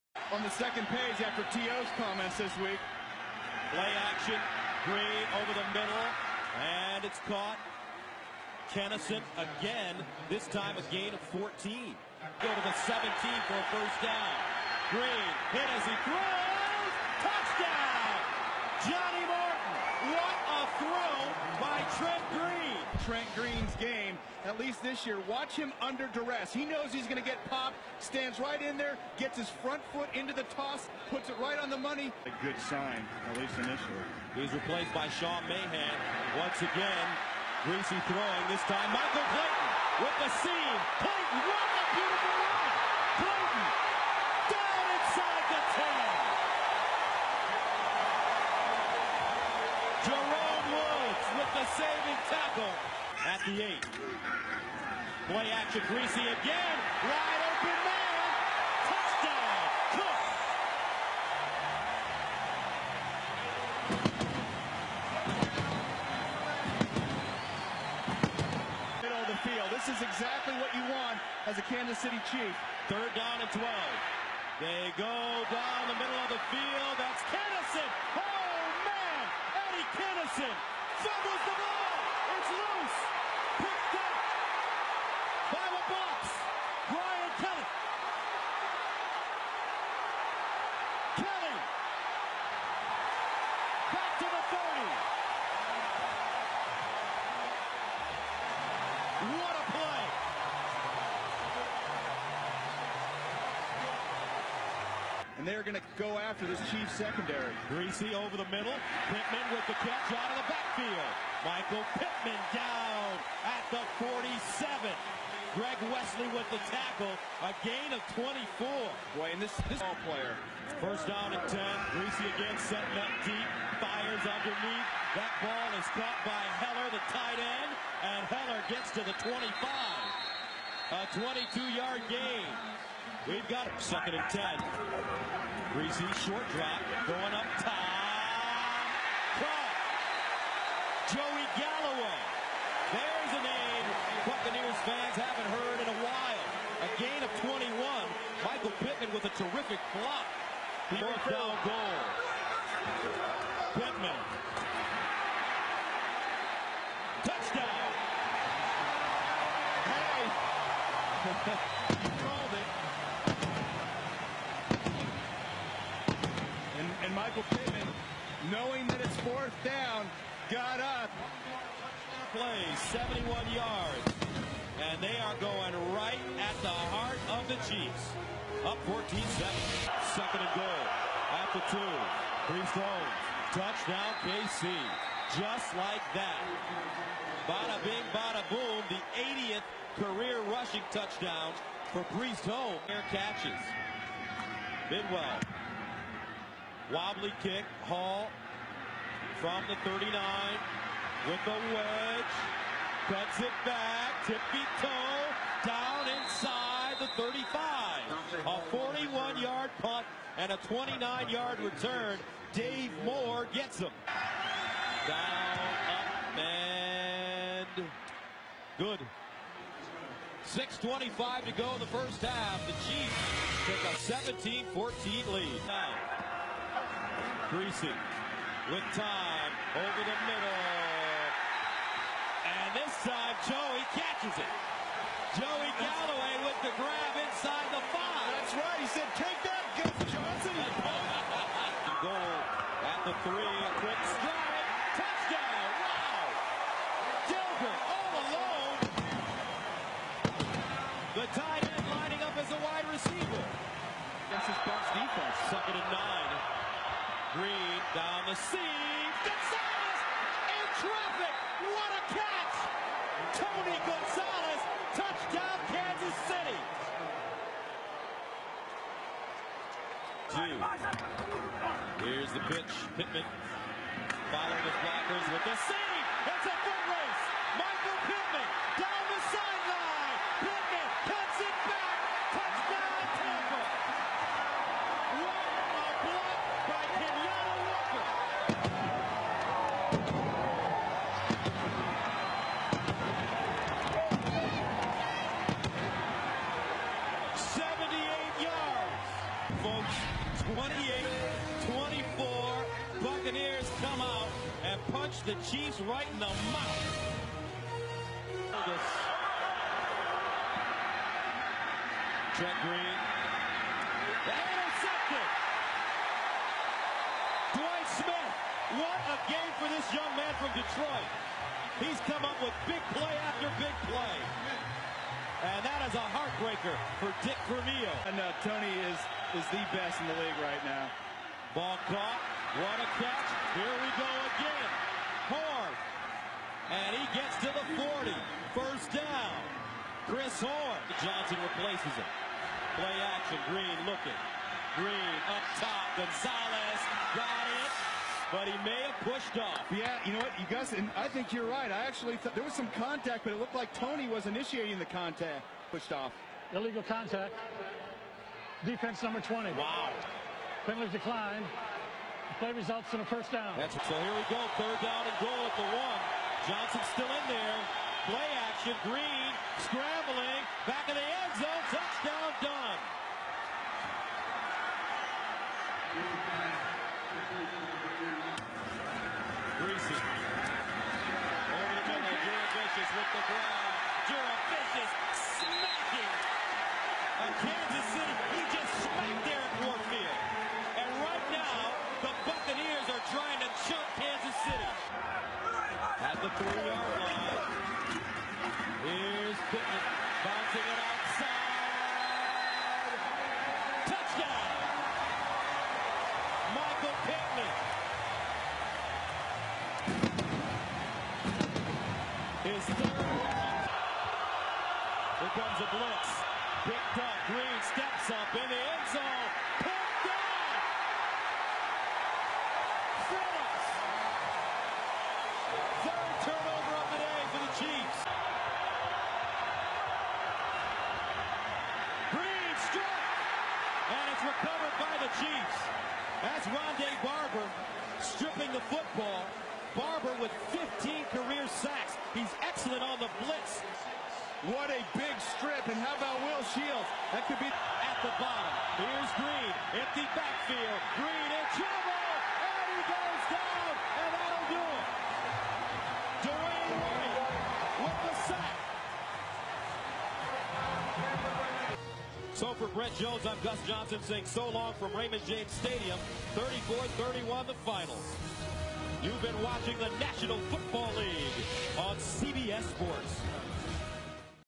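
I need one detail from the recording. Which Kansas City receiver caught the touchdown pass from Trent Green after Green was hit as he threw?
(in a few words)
Johnnie Morton.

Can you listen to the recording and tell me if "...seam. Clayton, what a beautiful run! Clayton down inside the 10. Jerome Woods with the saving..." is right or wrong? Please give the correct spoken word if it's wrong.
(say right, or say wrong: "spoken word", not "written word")
right.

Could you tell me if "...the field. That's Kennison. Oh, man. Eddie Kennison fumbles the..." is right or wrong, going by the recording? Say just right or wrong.
right.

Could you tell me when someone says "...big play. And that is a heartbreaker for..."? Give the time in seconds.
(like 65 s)
323 s.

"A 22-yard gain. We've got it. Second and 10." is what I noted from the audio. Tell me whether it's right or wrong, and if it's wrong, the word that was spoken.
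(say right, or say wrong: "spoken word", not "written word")
right.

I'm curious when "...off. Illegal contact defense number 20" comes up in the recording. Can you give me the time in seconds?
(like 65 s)
355 s.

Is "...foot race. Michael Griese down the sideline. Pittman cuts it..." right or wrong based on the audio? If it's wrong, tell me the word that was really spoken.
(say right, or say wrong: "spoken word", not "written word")
wrong: "Pittman", not "Griese".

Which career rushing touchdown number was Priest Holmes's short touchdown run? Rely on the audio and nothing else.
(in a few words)
80th.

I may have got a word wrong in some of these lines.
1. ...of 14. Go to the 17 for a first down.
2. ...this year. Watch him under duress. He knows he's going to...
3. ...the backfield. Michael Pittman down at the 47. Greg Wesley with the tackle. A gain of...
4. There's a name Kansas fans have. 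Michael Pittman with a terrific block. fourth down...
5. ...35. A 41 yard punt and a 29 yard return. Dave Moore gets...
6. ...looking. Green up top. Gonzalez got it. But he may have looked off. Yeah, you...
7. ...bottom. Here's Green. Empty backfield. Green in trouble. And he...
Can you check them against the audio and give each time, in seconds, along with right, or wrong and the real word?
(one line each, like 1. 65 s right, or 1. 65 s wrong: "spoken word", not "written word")
1. 11 s right
2. 24 s right
3. 110 s right
4. 142 s wrong: "Buccaneers", not "Kansas"
5. 207 s right
6. 343 s wrong: "pushed", not "looked"
7. 448 s right.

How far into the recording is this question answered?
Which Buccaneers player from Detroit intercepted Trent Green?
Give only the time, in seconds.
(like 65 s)
317 s.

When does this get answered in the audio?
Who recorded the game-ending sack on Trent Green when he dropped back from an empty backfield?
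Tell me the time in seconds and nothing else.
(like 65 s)
456 s.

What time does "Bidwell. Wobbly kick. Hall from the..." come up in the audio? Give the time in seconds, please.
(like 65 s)
194 s.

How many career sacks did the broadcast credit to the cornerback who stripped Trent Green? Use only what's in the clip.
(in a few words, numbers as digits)
15.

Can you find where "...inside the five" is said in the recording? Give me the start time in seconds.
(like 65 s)
237 s.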